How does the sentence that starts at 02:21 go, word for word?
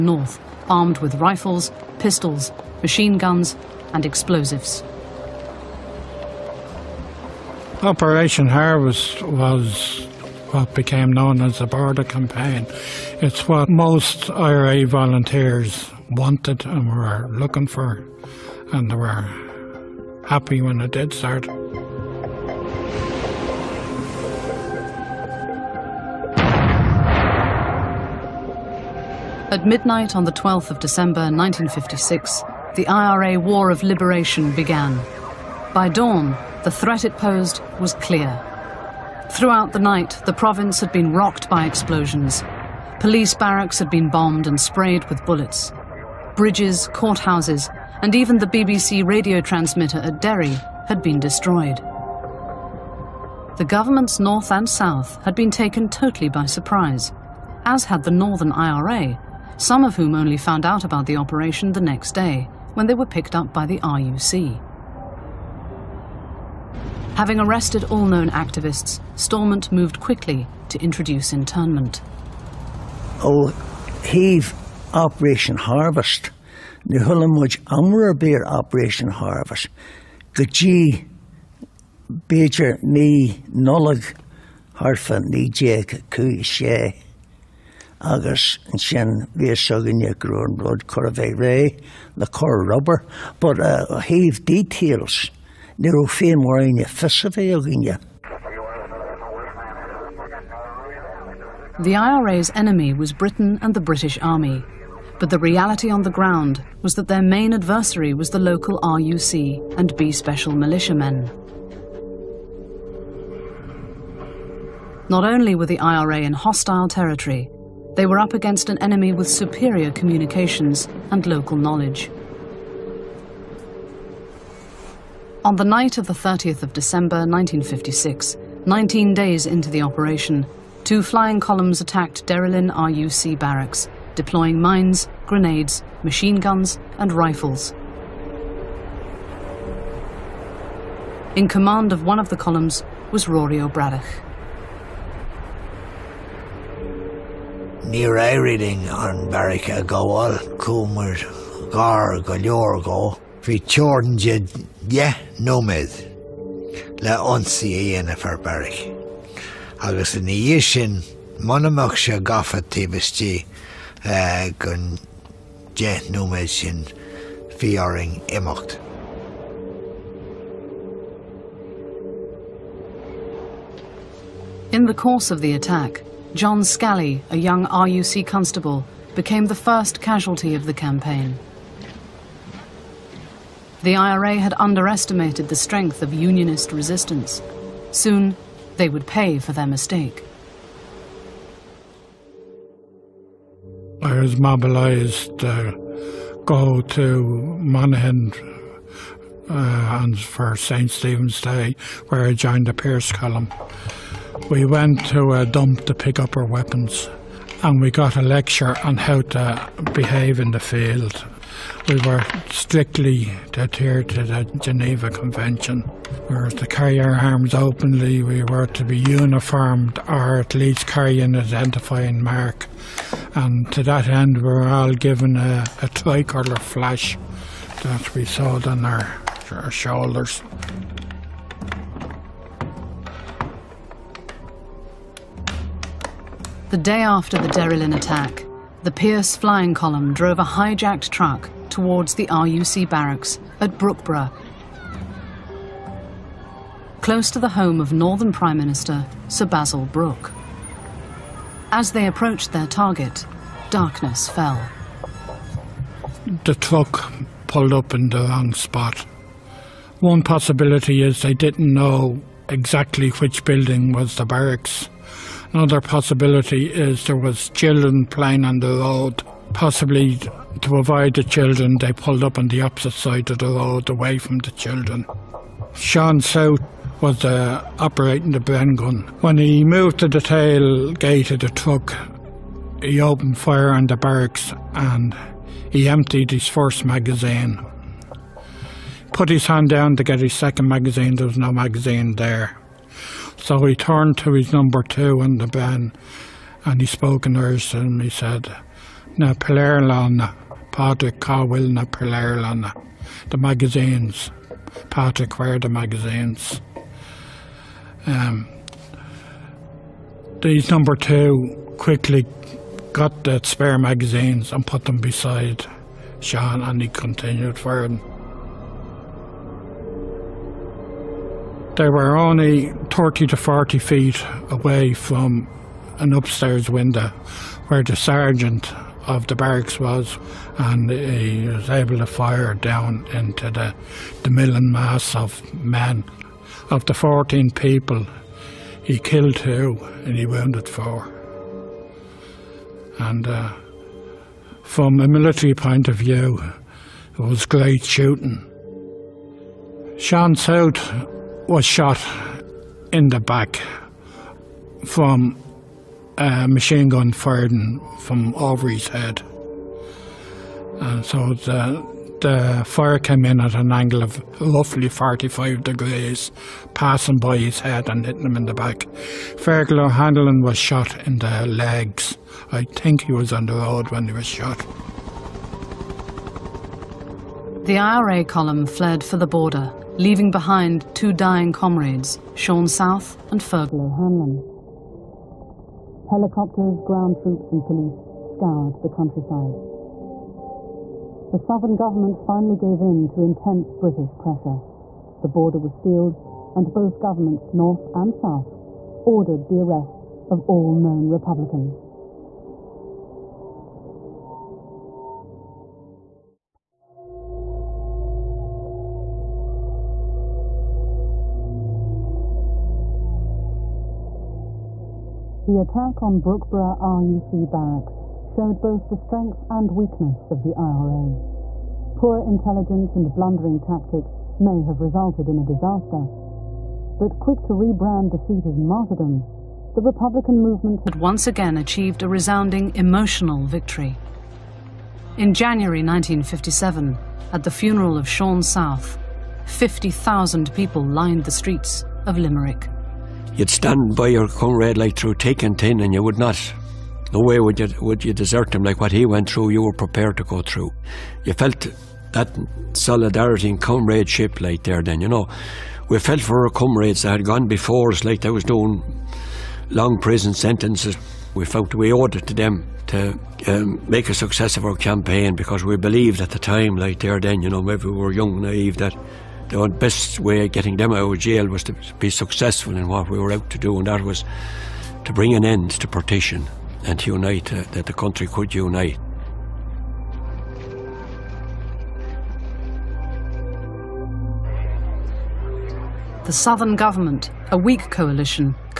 In command of one of the columns was Rory O'Braddock.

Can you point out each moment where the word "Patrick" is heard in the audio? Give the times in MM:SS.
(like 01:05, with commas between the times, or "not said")
05:00, 05:04.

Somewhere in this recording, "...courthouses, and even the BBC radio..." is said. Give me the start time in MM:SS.
00:46.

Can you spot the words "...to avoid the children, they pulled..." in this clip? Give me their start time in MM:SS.
04:30.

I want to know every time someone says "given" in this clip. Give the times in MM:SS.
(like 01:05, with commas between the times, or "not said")
03:44.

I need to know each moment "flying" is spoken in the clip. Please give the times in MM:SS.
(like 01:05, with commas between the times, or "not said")
02:11, 03:59.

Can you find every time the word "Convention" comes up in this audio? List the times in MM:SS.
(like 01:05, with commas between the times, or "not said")
03:35.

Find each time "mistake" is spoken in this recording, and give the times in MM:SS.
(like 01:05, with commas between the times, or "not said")
03:09.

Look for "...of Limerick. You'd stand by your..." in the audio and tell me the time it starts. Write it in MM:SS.
07:22.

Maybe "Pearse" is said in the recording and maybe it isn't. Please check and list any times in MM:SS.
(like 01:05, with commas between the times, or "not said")
03:22, 03:58.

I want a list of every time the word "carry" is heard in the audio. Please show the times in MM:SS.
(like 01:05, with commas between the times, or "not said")
03:36, 03:40.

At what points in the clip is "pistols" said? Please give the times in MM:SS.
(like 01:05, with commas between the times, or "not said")
00:01.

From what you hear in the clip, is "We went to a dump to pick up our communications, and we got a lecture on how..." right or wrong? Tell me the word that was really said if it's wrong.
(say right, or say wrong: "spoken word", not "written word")
wrong: "weapons", not "communications".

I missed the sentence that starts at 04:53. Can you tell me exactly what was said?
So he turned to his number two in the Bren and he spoke in Irish to him.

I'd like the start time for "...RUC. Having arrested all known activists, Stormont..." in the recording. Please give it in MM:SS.
01:03.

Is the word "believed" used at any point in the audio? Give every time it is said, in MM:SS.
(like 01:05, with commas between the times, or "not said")
07:45.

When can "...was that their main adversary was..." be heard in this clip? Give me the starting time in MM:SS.
01:46.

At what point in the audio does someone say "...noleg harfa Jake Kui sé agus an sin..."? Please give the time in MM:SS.
01:23.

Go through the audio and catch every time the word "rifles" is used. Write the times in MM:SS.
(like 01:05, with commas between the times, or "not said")
00:01, 02:17.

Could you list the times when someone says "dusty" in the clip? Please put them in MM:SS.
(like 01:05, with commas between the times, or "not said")
not said.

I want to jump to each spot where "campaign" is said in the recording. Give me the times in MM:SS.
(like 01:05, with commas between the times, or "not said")
00:12, 03:00, 07:44.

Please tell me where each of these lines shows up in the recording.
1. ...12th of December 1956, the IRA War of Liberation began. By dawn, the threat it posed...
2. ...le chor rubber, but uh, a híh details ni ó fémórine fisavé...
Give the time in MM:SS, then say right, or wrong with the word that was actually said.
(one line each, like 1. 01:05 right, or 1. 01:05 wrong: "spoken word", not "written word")
1. 00:30 right
2. 01:32 right.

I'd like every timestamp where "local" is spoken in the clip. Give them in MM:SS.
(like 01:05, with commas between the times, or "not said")
01:48, 02:01.